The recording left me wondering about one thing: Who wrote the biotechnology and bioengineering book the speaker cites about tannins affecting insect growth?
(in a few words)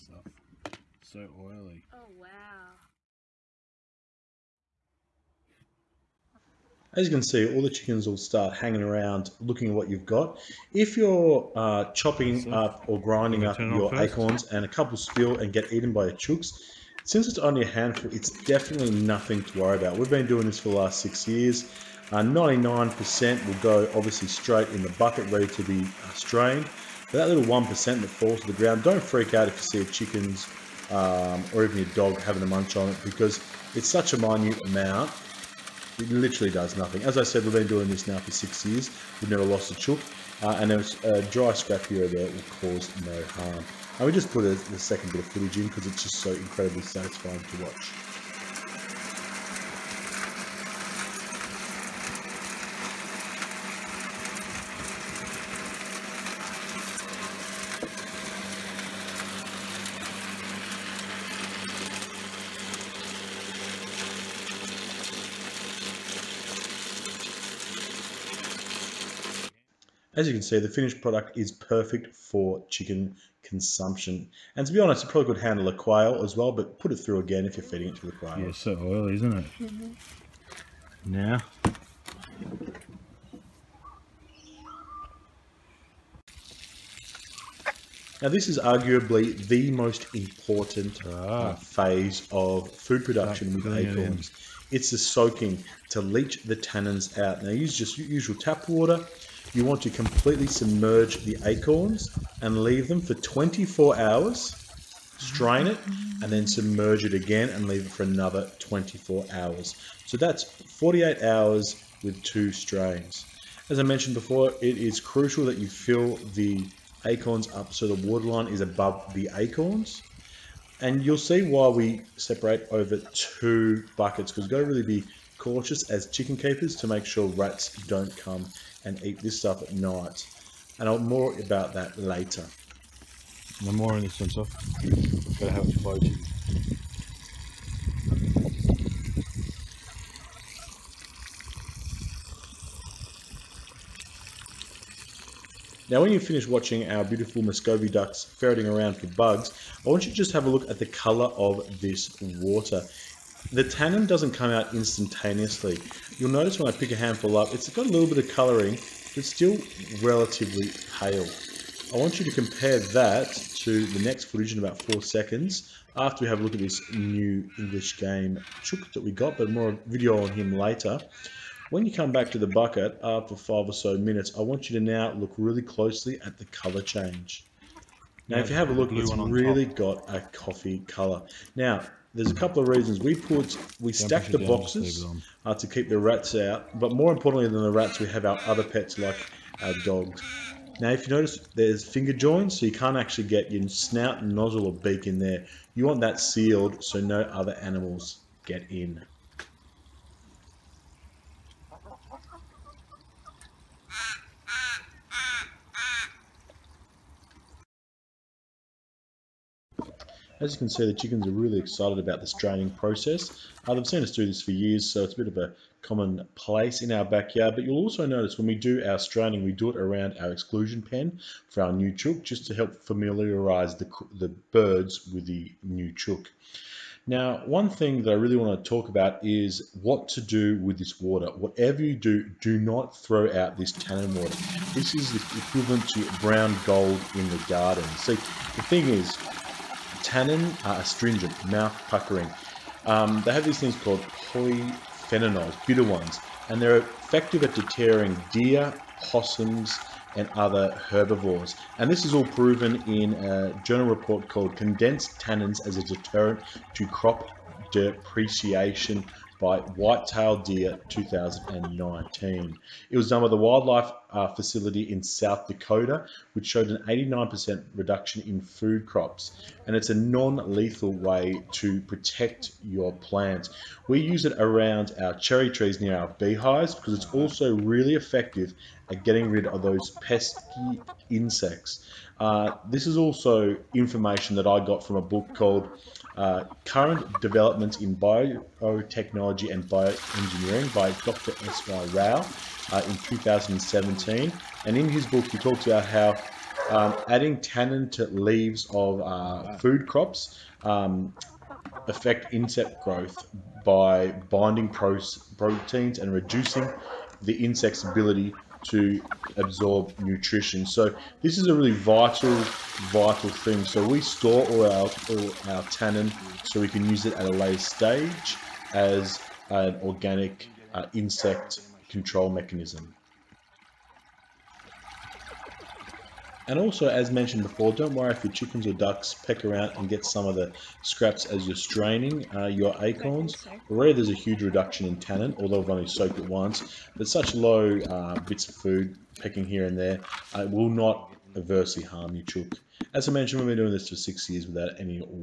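Dr. S.Y. Rao.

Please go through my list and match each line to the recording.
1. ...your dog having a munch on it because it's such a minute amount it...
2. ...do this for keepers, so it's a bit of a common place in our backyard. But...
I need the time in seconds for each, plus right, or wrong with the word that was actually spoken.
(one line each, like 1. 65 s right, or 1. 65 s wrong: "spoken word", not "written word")
1. 31 s right
2. 214 s wrong: "years", not "keepers".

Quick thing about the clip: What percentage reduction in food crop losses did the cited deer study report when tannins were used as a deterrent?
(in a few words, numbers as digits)
89%.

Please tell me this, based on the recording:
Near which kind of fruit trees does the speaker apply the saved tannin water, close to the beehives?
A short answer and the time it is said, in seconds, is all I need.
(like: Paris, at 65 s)
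Cherry trees, at 275 s.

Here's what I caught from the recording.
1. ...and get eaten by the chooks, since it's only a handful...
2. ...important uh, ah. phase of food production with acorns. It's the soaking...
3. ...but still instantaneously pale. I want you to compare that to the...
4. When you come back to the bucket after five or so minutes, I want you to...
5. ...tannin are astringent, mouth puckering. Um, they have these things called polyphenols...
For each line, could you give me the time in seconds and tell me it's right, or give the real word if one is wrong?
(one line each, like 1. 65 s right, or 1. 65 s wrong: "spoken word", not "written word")
1. 15 s right
2. 90 s right
3. 159 s wrong: "relatively", not "instantaneously"
4. 171 s right
5. 240 s right.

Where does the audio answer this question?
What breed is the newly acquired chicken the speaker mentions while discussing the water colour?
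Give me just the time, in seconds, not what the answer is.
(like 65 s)
167 s.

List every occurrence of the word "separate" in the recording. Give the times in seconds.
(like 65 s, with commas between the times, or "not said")
122 s.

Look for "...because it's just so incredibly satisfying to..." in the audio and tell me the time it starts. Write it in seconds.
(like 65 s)
45 s.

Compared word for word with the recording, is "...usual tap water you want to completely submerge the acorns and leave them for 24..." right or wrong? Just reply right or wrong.
right.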